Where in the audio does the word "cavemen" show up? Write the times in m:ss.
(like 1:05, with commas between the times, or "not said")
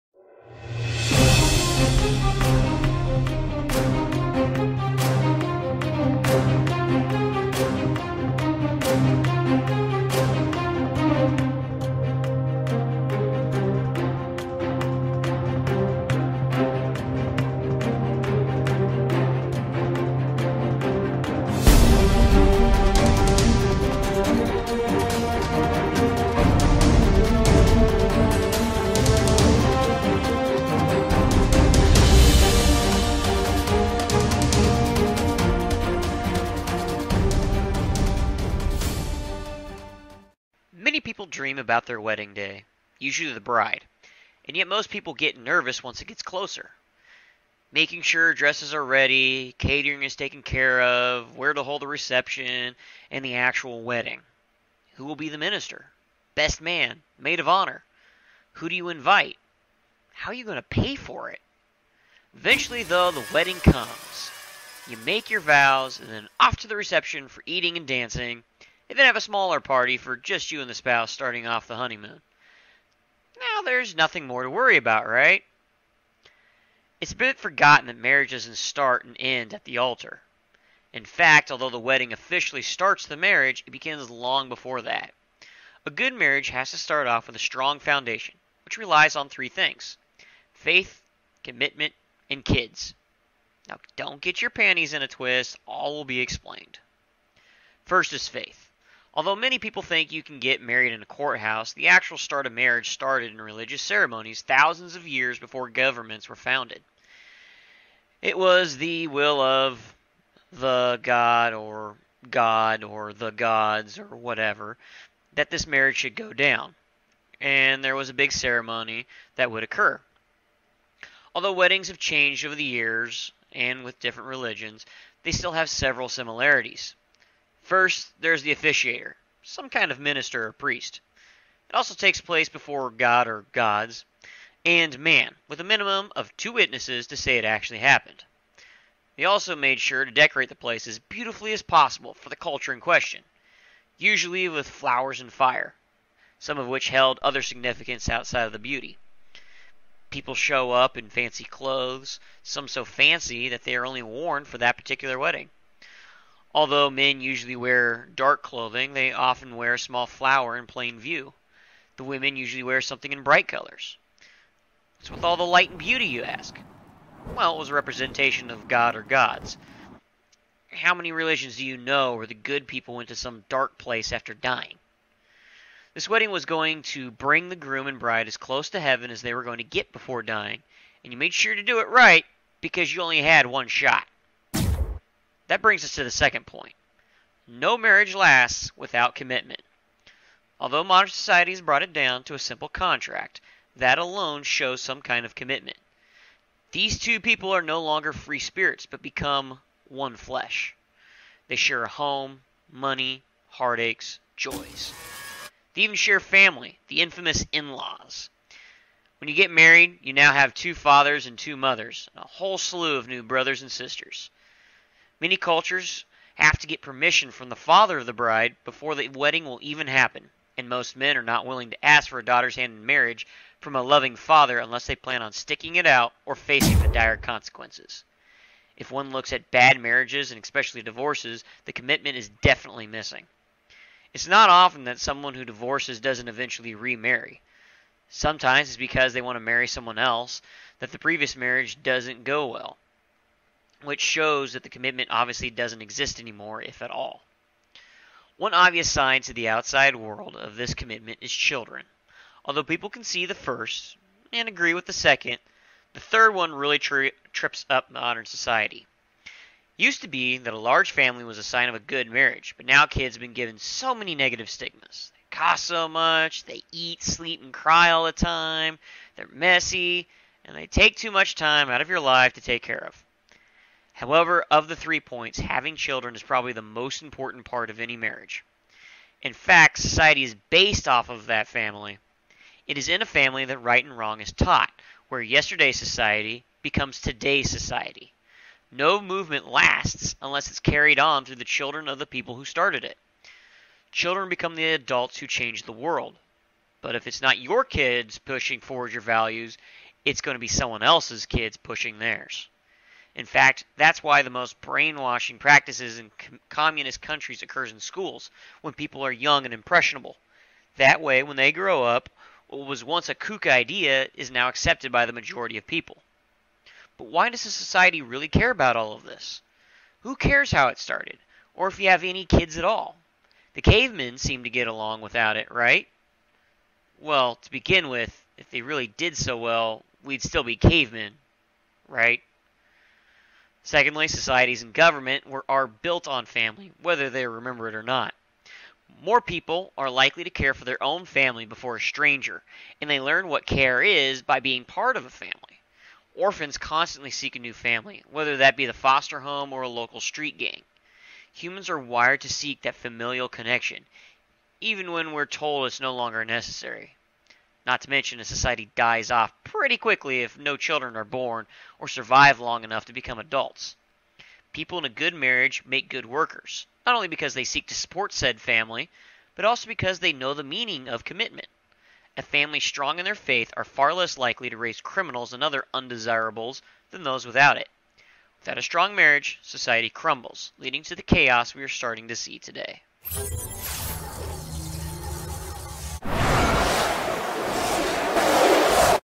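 5:23, 5:30.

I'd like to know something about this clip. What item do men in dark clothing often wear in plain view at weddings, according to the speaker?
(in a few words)
a small flower.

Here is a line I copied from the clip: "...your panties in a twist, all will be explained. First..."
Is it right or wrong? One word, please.
right.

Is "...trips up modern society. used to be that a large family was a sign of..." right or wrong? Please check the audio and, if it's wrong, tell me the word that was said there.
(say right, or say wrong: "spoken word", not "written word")
right.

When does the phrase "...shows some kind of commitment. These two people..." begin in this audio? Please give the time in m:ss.
3:14.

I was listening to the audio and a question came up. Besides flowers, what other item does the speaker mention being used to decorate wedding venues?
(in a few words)
fire.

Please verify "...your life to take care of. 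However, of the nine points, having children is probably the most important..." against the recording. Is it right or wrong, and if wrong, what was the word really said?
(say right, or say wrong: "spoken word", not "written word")
wrong: "three", not "nine".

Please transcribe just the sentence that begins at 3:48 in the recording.
If one looks at bad marriages and especially divorces, the commitment is definitely missing.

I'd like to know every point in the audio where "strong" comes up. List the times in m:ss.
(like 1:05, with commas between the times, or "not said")
1:27, 6:12, 6:18.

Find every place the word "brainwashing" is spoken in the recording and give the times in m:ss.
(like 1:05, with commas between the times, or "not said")
5:04.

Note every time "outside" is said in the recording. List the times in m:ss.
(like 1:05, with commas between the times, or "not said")
2:28, 4:09.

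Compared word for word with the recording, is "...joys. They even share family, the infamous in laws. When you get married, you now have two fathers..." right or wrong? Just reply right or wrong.
right.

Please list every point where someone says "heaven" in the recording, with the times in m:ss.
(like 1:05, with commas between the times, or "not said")
2:58.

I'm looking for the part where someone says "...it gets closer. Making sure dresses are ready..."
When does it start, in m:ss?
0:46.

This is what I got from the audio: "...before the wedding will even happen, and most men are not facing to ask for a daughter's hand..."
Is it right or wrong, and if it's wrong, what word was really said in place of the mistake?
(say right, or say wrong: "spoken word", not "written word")
wrong: "willing", not "facing".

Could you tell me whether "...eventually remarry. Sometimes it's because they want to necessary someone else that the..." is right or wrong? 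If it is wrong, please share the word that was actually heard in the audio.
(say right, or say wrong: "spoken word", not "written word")
wrong: "marry", not "necessary".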